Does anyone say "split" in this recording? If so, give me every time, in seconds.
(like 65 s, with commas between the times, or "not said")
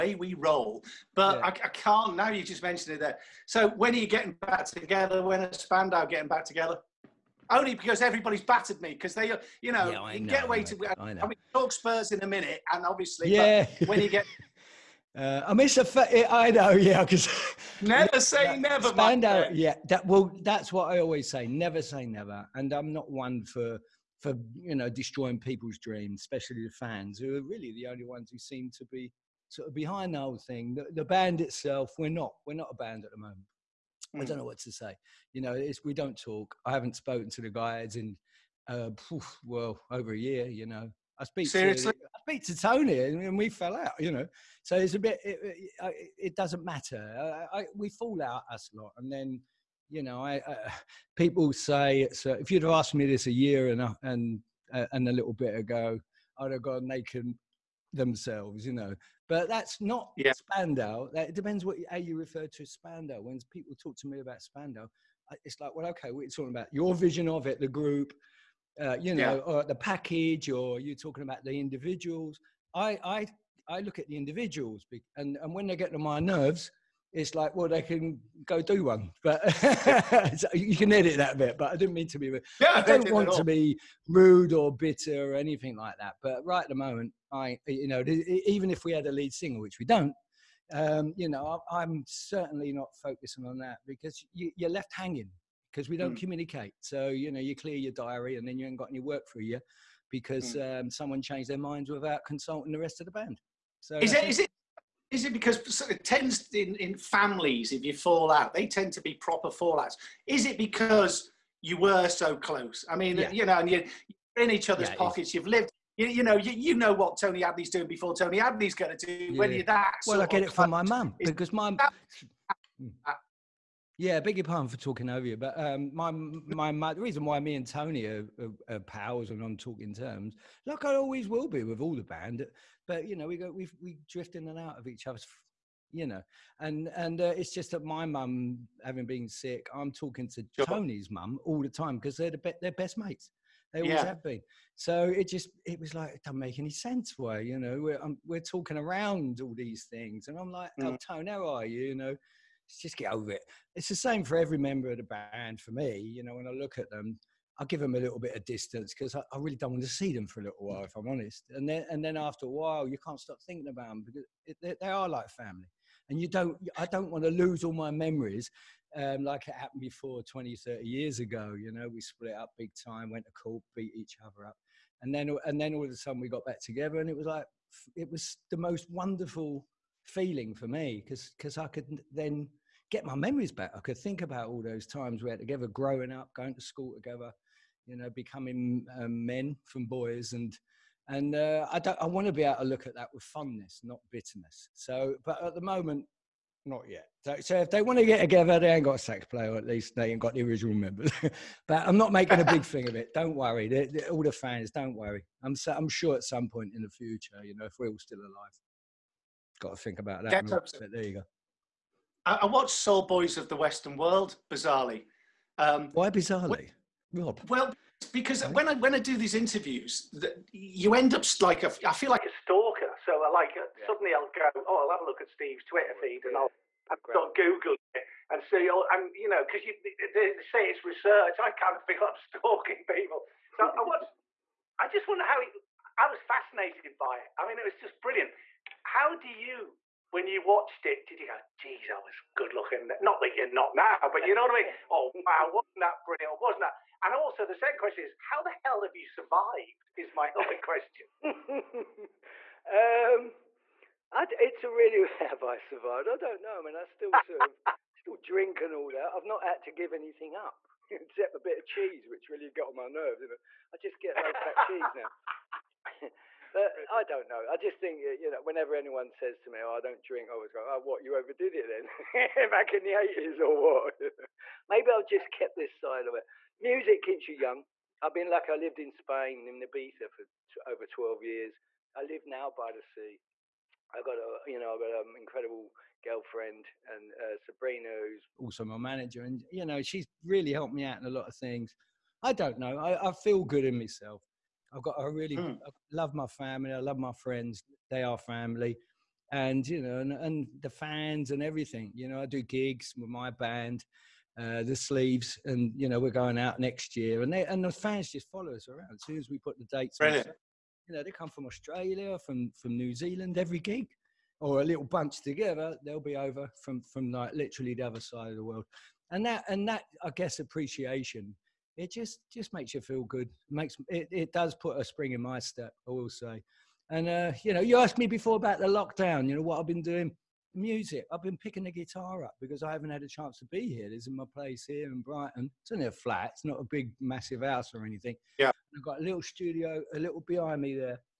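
172 s.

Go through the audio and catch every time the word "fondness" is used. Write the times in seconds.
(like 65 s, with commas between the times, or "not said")
193 s.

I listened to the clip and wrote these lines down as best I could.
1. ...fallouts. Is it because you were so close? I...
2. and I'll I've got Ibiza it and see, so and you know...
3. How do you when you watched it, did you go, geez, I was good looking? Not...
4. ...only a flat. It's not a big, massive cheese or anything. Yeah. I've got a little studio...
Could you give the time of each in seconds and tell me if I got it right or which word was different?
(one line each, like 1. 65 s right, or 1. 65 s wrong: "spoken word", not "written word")
1. 109 s right
2. 226 s wrong: "Google", not "Ibiza"
3. 238 s right
4. 335 s wrong: "house", not "cheese".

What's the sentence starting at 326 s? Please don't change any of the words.
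And uh, you know, you asked me before about the lockdown.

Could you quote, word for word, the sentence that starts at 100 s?
um, someone changed their minds without consulting the rest of the band.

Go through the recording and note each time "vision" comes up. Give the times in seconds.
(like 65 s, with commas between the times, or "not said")
66 s.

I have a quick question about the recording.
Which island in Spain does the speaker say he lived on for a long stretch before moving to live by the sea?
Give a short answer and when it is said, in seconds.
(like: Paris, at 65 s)
Ibiza, at 279 s.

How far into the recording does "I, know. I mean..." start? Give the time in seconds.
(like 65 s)
10 s.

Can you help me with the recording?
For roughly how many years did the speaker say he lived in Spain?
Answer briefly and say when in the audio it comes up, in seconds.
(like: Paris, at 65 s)
12, at 280 s.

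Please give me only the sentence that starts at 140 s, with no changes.
Tony's mum all the time because they're the be- they're best mates.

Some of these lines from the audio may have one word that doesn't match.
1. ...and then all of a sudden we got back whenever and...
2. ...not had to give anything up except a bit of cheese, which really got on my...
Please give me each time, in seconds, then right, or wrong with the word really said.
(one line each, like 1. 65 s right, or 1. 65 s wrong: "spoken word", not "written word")
1. 175 s wrong: "together", not "whenever"
2. 259 s right.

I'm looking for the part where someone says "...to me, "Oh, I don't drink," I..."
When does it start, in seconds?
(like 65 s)
269 s.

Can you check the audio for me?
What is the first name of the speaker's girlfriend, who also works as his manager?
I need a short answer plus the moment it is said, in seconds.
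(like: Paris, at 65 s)
Sabrina, at 287 s.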